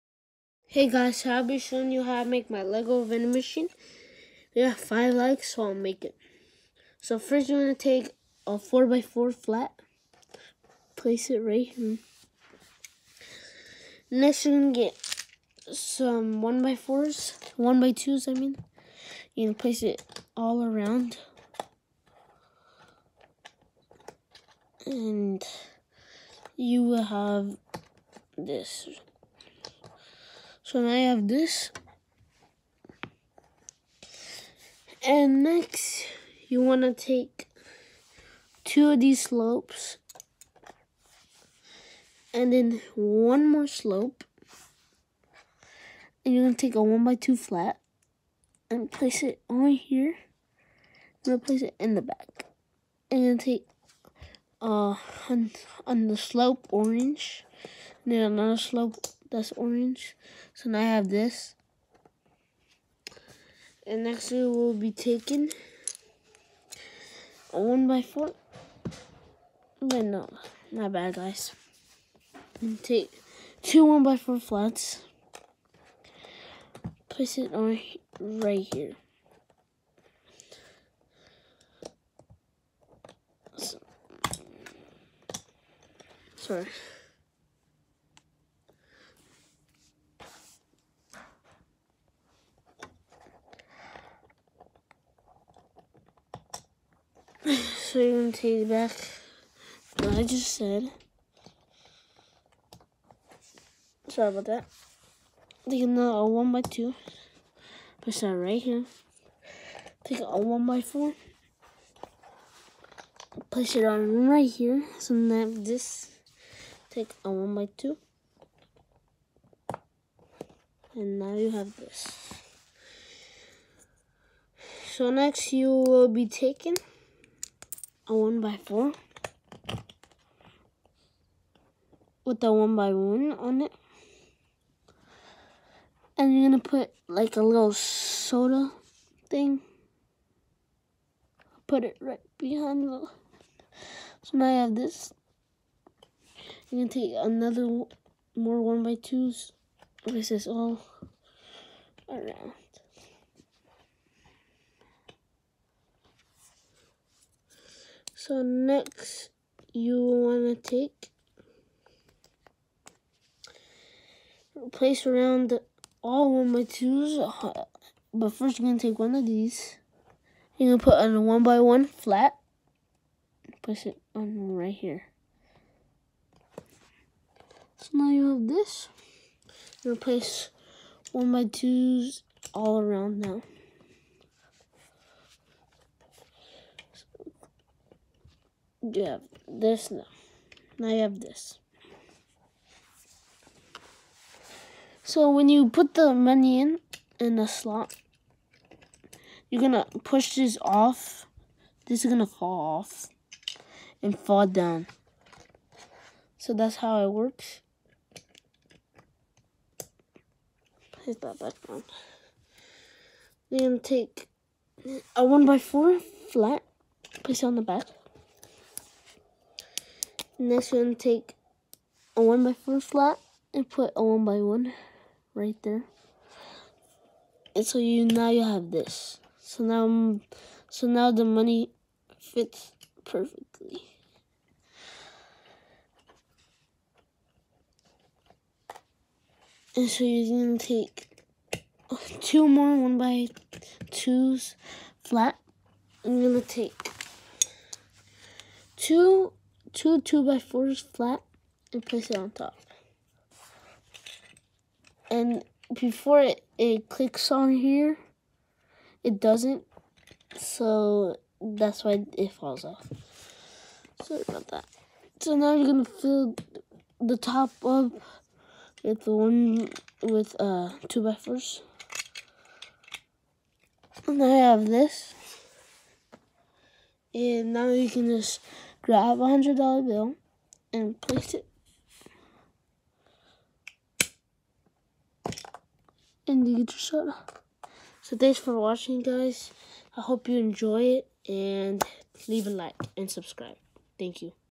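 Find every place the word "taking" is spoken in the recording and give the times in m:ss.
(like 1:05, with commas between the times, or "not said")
1:04, 2:06.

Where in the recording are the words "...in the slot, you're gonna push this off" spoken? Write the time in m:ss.
3:17.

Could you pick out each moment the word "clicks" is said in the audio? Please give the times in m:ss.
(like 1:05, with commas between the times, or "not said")
4:16.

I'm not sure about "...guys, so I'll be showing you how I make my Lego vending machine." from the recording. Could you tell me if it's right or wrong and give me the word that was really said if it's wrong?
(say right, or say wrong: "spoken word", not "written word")
right.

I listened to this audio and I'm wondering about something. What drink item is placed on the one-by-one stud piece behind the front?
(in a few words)
Soda.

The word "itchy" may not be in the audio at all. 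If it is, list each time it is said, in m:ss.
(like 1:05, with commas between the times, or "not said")
not said.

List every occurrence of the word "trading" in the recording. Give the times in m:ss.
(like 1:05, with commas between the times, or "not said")
not said.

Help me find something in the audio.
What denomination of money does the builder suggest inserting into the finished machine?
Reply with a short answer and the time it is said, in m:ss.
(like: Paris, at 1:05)
$100, at 4:39.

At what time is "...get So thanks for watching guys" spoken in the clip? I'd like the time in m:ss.
4:46.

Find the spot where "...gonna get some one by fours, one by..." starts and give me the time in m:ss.
0:14.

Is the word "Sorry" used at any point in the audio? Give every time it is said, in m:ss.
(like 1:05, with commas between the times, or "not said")
1:26, 1:44, 4:24.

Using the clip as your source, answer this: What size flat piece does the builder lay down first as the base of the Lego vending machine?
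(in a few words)
4 by 4.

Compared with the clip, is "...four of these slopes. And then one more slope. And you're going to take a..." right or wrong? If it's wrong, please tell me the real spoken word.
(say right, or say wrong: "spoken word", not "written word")
wrong: "two", not "four".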